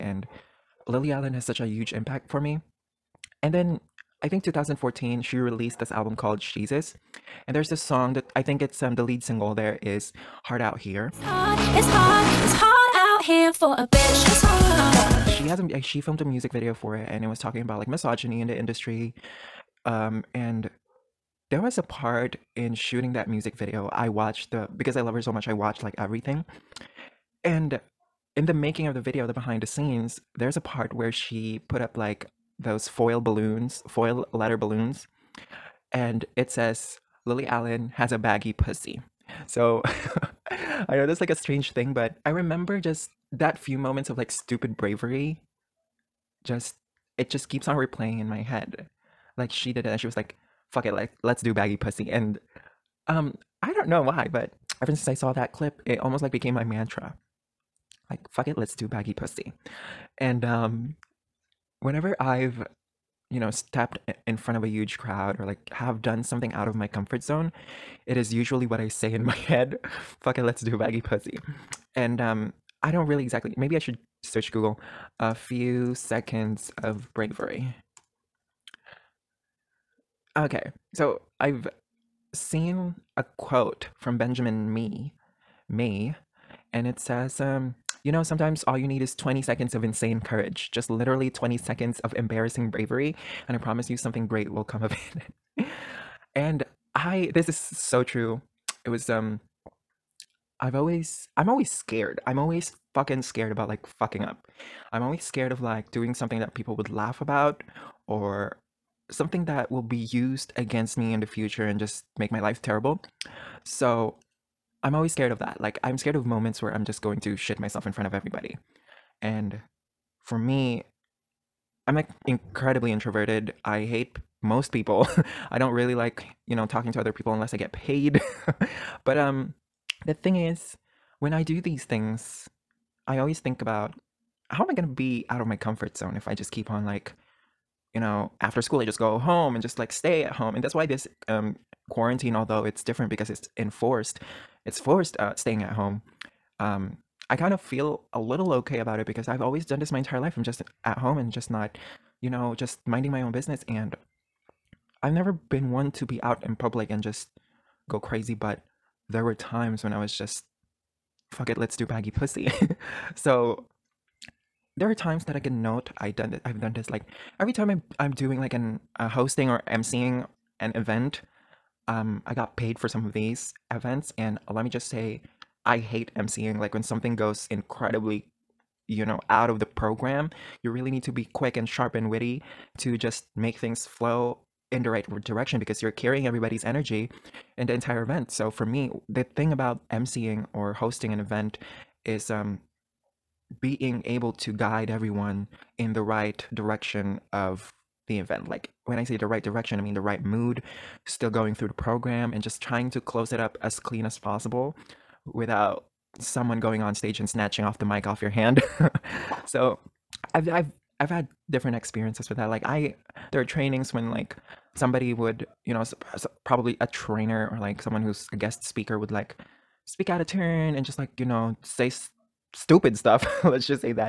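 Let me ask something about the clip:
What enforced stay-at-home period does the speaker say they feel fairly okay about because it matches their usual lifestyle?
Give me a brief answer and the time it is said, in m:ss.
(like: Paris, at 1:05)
Quarantine, at 2:21.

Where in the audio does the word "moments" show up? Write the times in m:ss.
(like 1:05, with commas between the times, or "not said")
0:43, 1:56.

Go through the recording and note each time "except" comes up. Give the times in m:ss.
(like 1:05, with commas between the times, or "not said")
not said.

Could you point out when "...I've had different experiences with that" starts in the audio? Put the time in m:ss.
3:30.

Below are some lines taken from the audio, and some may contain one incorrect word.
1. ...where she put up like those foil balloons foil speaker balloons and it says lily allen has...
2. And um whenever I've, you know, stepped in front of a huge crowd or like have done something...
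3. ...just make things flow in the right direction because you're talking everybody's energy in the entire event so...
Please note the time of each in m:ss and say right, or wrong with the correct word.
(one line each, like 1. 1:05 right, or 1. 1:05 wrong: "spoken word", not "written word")
1. 0:30 wrong: "letter", not "speaker"
2. 1:00 right
3. 3:02 wrong: "carrying", not "talking".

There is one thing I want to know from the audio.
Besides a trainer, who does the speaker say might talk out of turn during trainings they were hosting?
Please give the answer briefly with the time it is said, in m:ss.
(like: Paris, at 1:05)
A guest speaker, at 3:38.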